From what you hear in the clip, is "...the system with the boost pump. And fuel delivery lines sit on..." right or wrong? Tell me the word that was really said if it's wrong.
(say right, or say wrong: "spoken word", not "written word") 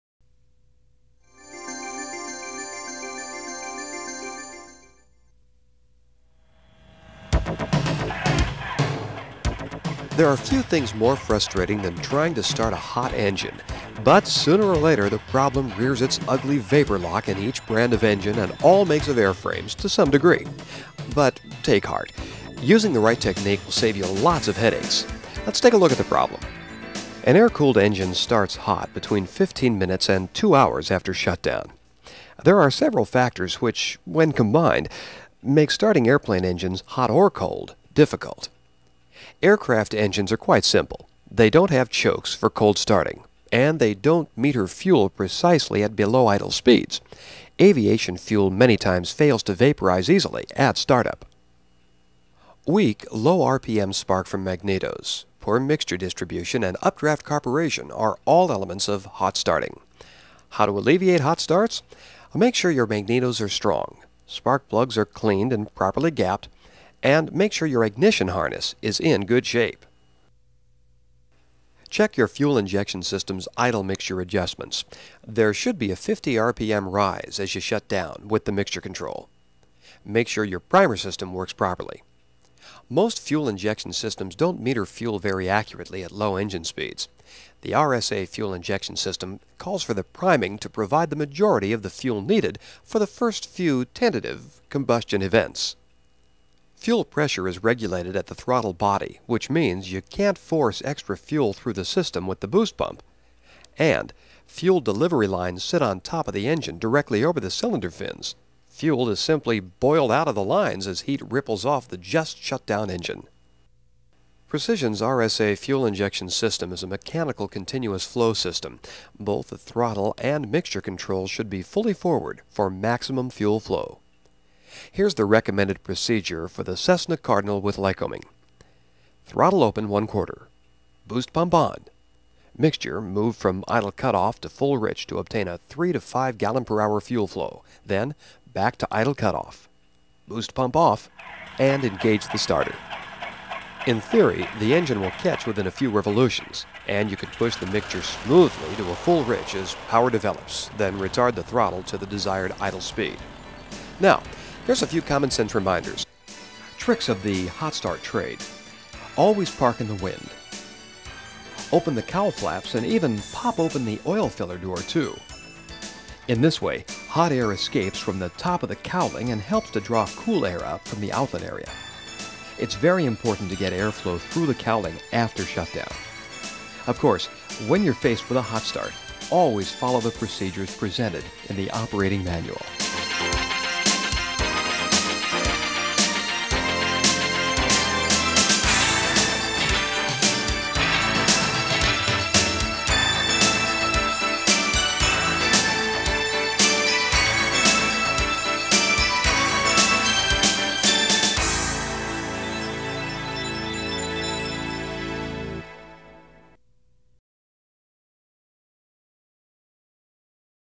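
right.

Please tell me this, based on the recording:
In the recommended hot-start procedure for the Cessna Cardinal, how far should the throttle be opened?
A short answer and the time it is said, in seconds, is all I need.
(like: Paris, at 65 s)
one quarter, at 129 s.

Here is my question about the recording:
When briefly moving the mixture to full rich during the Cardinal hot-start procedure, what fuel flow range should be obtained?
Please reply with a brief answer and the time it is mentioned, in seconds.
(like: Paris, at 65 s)
3 to 5 gallons per hour, at 135 s.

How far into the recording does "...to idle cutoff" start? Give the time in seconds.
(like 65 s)
138 s.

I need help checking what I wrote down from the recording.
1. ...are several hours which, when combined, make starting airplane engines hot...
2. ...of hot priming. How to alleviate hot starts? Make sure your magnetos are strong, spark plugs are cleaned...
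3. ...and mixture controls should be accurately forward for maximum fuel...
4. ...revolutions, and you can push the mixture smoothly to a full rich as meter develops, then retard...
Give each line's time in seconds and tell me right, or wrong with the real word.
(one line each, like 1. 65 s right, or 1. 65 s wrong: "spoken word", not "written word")
1. 32 s wrong: "factors", not "hours"
2. 58 s wrong: "starting", not "priming"
3. 120 s wrong: "fully", not "accurately"
4. 145 s wrong: "power", not "meter".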